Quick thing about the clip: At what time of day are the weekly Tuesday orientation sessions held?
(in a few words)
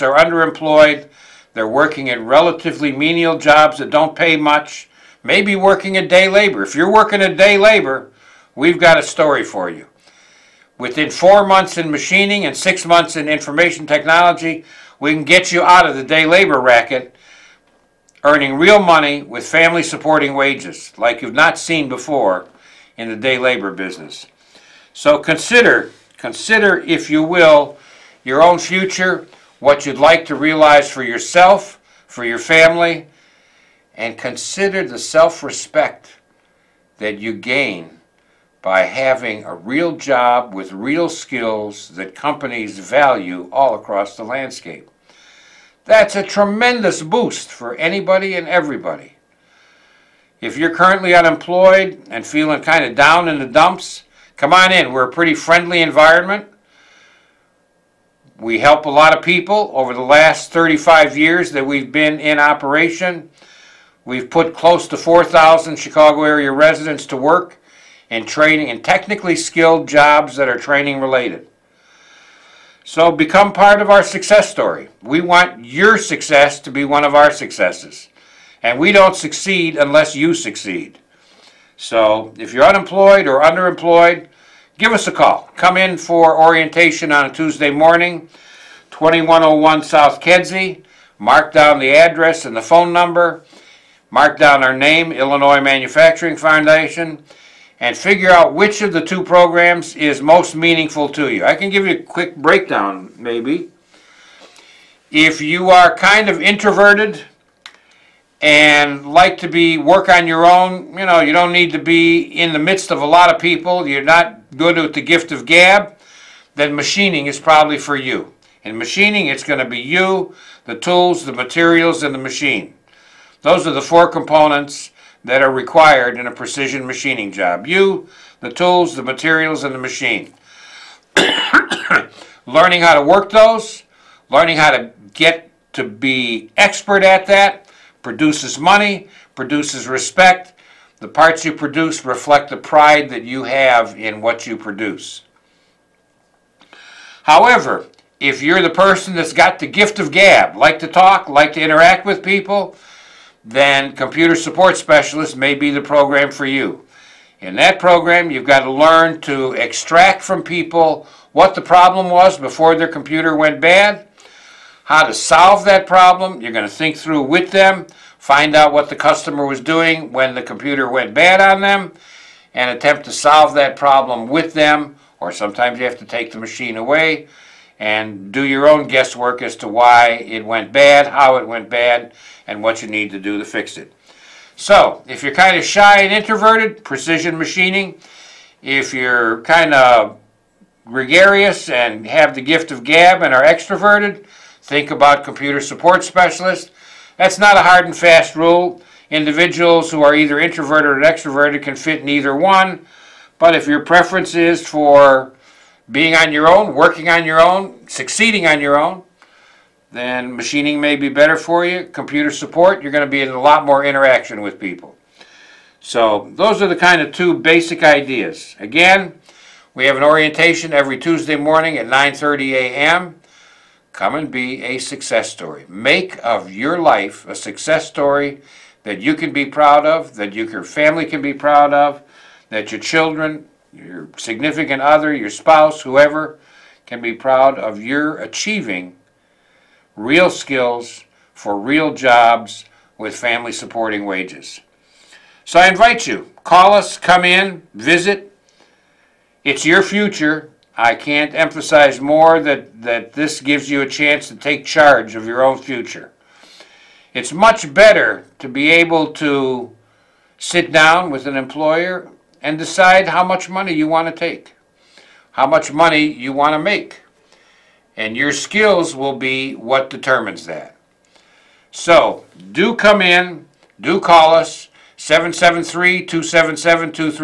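9:30 a.m.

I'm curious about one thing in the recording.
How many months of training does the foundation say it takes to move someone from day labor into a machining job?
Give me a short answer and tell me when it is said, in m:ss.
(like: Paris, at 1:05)
4 months, at 0:11.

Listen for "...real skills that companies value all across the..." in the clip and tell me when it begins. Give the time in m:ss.
0:40.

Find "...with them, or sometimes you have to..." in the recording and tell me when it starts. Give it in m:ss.
2:54.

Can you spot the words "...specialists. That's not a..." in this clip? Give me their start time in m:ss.
3:16.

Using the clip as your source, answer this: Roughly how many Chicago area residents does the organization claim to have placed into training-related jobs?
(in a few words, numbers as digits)
4,000.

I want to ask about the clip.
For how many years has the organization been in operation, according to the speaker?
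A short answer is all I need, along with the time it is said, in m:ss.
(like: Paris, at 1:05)
35 years, at 1:00.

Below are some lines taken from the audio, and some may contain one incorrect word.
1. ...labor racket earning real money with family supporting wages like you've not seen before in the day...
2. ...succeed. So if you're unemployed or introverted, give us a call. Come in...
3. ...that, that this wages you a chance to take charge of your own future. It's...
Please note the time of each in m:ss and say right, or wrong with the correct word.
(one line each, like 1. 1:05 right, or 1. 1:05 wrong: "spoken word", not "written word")
1. 0:16 right
2. 1:20 wrong: "underemployed", not "introverted"
3. 4:12 wrong: "gives", not "wages".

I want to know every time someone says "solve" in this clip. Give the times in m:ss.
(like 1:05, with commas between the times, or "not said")
2:45, 2:53.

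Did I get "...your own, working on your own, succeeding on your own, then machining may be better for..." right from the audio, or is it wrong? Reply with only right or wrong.
right.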